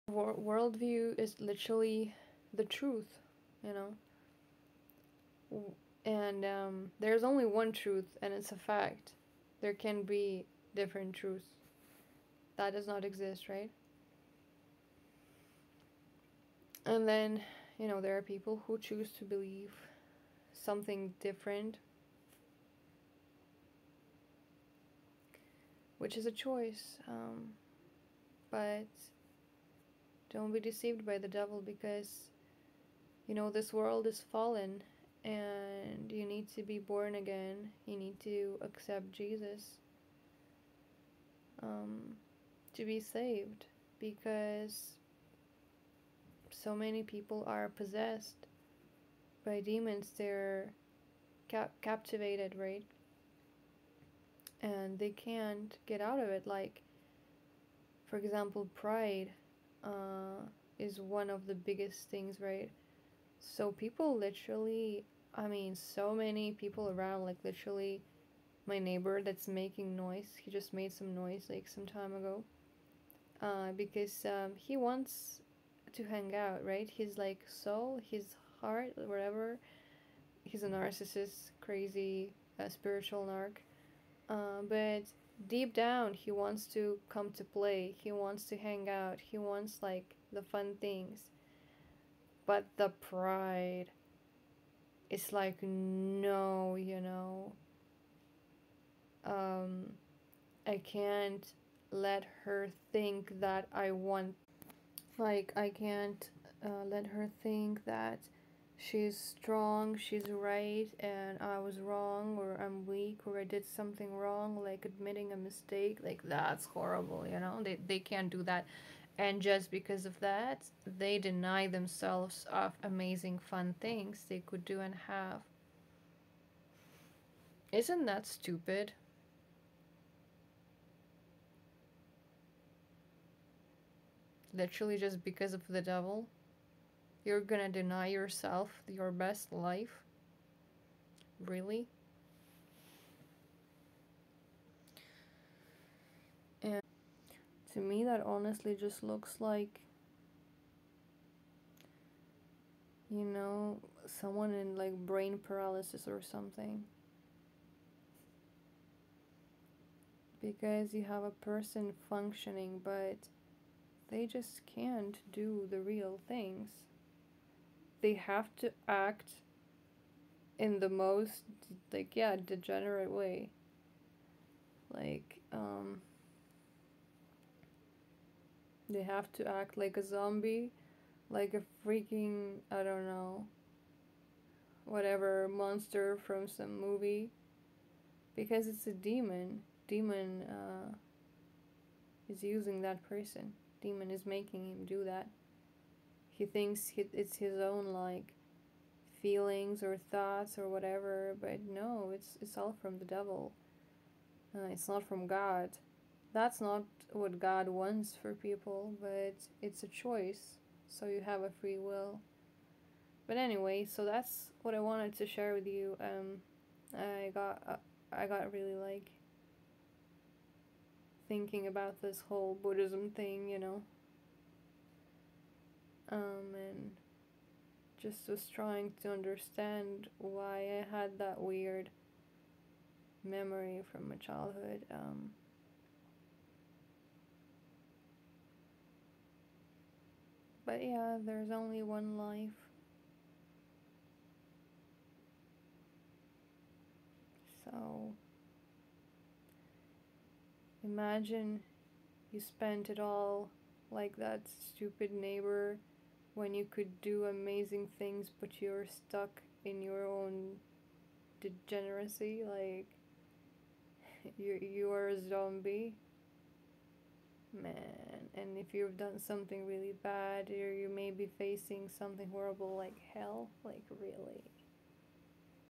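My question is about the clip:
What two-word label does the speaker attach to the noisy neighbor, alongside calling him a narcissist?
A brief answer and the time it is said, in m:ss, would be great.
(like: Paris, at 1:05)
Spiritual narc, at 1:22.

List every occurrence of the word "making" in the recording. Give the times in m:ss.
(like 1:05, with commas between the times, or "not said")
1:09, 3:14.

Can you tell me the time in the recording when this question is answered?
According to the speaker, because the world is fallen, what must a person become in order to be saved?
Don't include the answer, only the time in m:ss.
0:36.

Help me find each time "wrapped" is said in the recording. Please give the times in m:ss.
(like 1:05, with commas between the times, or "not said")
not said.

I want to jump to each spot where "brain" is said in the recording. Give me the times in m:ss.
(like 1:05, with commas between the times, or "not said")
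2:34.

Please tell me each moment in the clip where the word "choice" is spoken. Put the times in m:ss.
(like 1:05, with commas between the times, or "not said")
0:26, 3:29.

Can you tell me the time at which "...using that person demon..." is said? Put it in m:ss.
3:12.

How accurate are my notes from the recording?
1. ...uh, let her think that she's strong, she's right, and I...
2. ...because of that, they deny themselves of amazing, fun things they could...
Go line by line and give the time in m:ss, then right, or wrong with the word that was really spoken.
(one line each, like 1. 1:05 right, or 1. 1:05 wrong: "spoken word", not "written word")
1. 1:46 right
2. 1:59 right.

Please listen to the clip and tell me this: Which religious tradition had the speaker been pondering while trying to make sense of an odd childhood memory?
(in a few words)
Buddhism.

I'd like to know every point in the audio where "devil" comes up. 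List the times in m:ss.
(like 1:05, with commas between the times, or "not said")
0:31, 2:15, 3:23.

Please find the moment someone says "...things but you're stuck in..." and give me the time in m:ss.
4:17.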